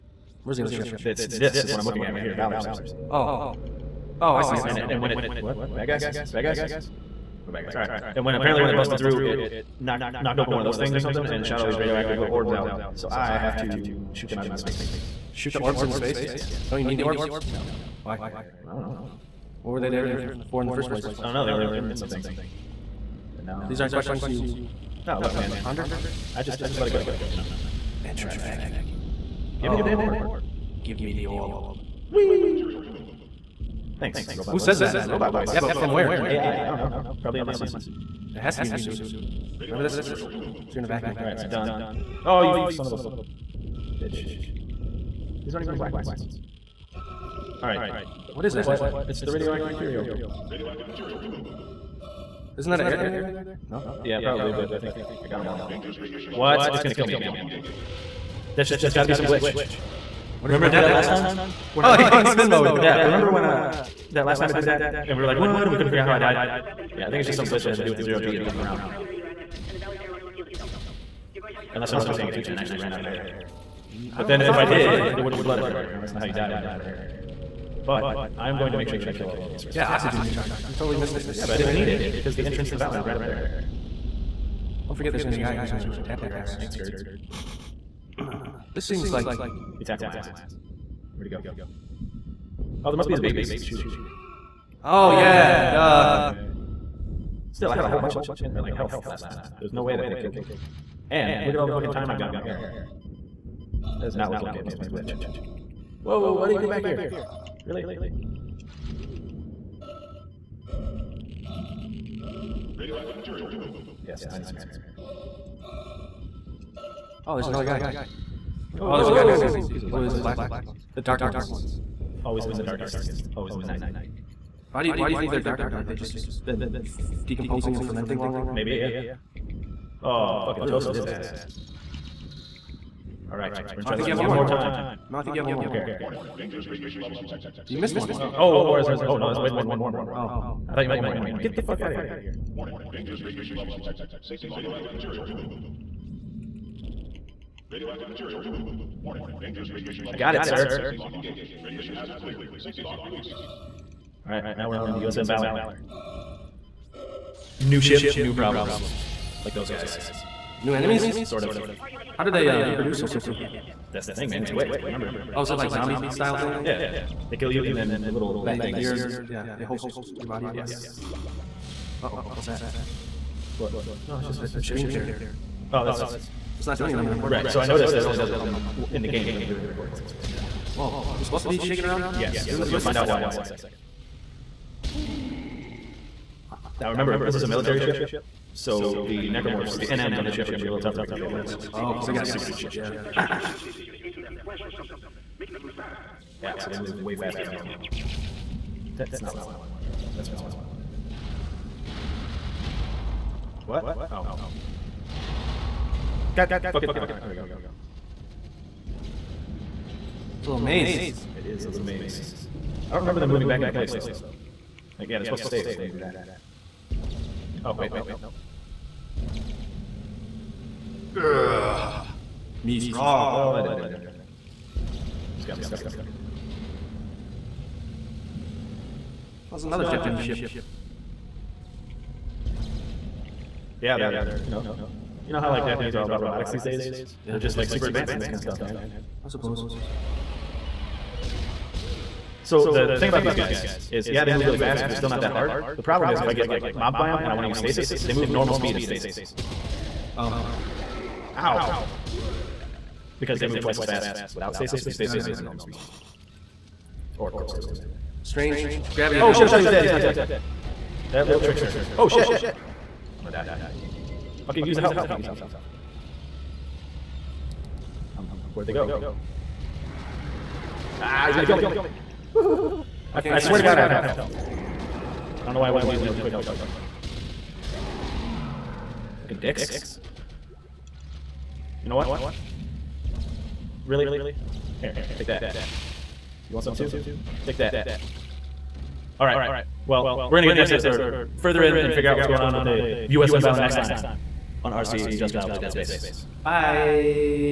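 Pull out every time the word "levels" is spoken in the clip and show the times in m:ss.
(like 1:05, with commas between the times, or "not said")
2:17, 2:23, 2:30.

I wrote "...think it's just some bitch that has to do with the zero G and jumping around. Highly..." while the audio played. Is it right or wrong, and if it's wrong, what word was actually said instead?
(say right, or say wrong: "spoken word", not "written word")
wrong: "glitch", not "bitch".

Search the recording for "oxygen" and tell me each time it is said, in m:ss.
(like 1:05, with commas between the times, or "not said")
1:19.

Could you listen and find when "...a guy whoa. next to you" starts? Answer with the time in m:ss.
1:59.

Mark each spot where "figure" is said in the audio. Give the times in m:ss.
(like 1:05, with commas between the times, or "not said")
1:05, 4:51.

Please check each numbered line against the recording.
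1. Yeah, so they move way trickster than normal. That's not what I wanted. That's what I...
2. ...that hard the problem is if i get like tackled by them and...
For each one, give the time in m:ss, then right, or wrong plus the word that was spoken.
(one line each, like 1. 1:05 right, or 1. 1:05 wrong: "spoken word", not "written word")
1. 3:16 wrong: "faster", not "trickster"
2. 4:05 wrong: "mobbed", not "tackled".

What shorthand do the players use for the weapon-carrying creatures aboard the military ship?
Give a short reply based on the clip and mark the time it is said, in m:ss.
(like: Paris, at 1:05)
NMs, at 3:09.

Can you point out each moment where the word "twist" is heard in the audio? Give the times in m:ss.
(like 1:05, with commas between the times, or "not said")
3:02.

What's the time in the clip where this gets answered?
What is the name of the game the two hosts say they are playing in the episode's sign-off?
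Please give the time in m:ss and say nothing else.
4:55.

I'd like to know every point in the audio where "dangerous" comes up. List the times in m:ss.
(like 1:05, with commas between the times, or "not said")
0:55, 2:16, 2:22, 2:29.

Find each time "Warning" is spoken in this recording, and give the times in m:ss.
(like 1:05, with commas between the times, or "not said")
2:15, 2:22, 2:29.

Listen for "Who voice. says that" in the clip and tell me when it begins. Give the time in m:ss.
0:34.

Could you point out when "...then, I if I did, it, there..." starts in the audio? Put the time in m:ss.
1:14.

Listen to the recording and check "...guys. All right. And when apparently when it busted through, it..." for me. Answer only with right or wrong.
right.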